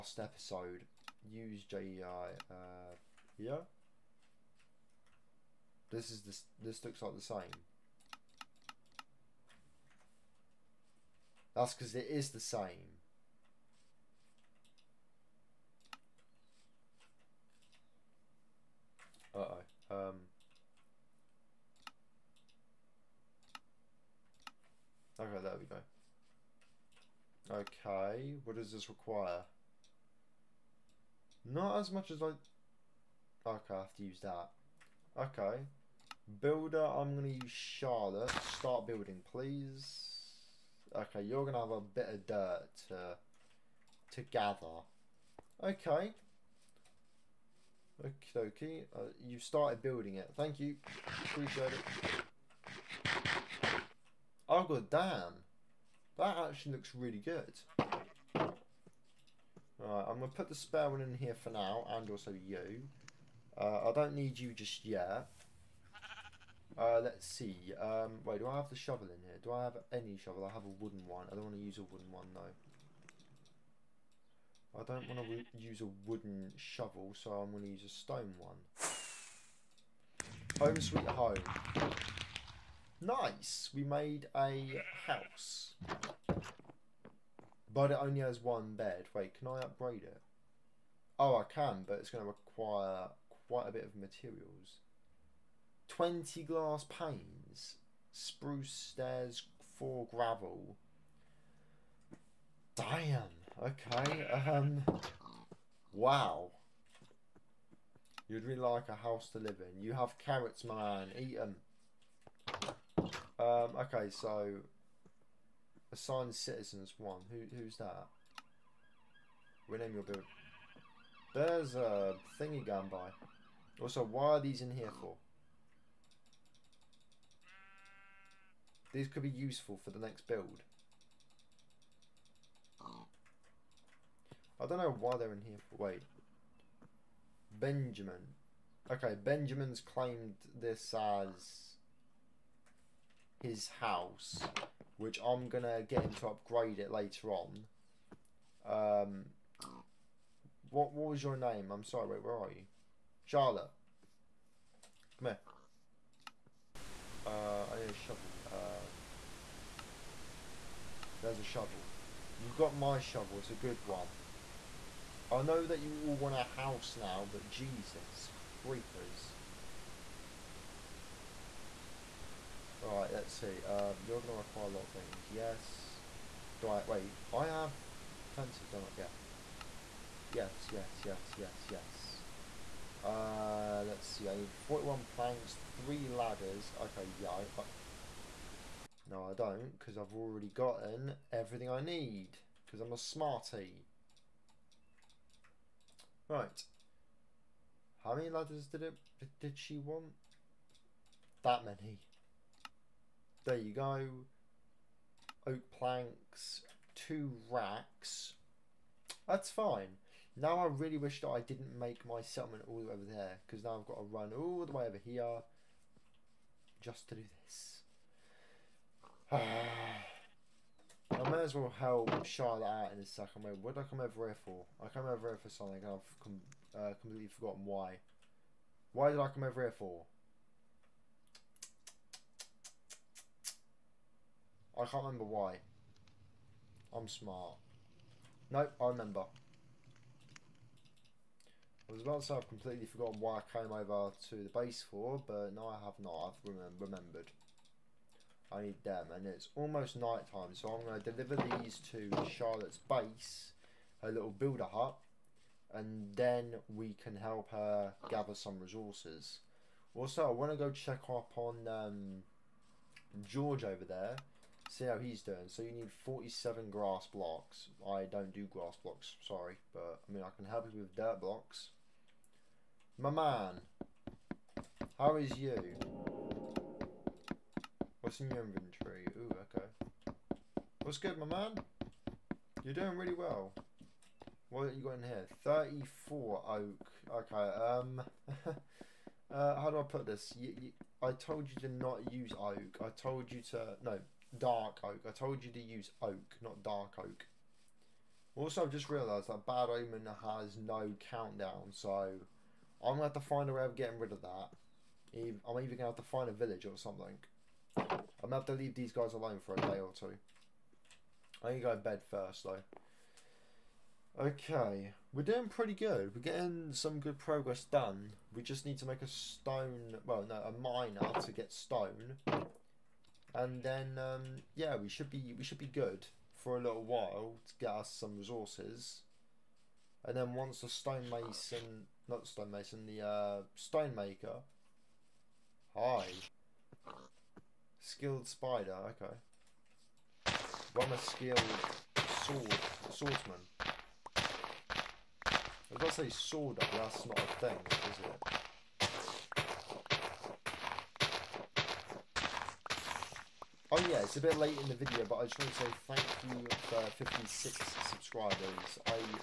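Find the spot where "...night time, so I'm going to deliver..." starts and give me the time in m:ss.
4:09.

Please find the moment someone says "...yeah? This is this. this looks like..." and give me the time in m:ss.
0:03.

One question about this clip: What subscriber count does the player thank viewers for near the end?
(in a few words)
56.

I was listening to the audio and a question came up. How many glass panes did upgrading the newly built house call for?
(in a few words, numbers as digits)
20.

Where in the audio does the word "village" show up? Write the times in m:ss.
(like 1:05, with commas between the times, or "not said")
5:06.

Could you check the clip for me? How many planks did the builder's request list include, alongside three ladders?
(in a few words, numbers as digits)
41.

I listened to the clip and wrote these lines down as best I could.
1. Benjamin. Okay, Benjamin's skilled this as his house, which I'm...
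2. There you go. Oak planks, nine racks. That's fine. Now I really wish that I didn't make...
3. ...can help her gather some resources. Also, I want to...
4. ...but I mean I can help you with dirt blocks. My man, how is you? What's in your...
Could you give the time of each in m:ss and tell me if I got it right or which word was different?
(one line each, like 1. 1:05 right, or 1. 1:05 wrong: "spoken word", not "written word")
1. 2:17 wrong: "claimed", not "skilled"
2. 3:23 wrong: "two", not "nine"
3. 4:17 right
4. 4:29 right.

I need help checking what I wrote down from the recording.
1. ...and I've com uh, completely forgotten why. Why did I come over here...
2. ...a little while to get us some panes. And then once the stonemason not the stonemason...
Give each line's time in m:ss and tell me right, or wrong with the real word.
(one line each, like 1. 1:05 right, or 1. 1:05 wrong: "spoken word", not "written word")
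1. 3:45 right
2. 5:26 wrong: "resources", not "panes".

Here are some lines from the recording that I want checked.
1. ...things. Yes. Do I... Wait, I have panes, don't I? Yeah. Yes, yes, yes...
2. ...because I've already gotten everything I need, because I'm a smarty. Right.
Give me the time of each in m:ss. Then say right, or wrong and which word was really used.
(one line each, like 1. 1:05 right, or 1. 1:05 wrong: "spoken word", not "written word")
1. 2:54 wrong: "fences", not "panes"
2. 3:09 right.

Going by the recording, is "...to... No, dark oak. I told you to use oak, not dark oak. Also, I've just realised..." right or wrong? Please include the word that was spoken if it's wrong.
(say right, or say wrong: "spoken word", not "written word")
right.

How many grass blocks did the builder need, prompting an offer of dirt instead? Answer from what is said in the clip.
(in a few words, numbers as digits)
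47.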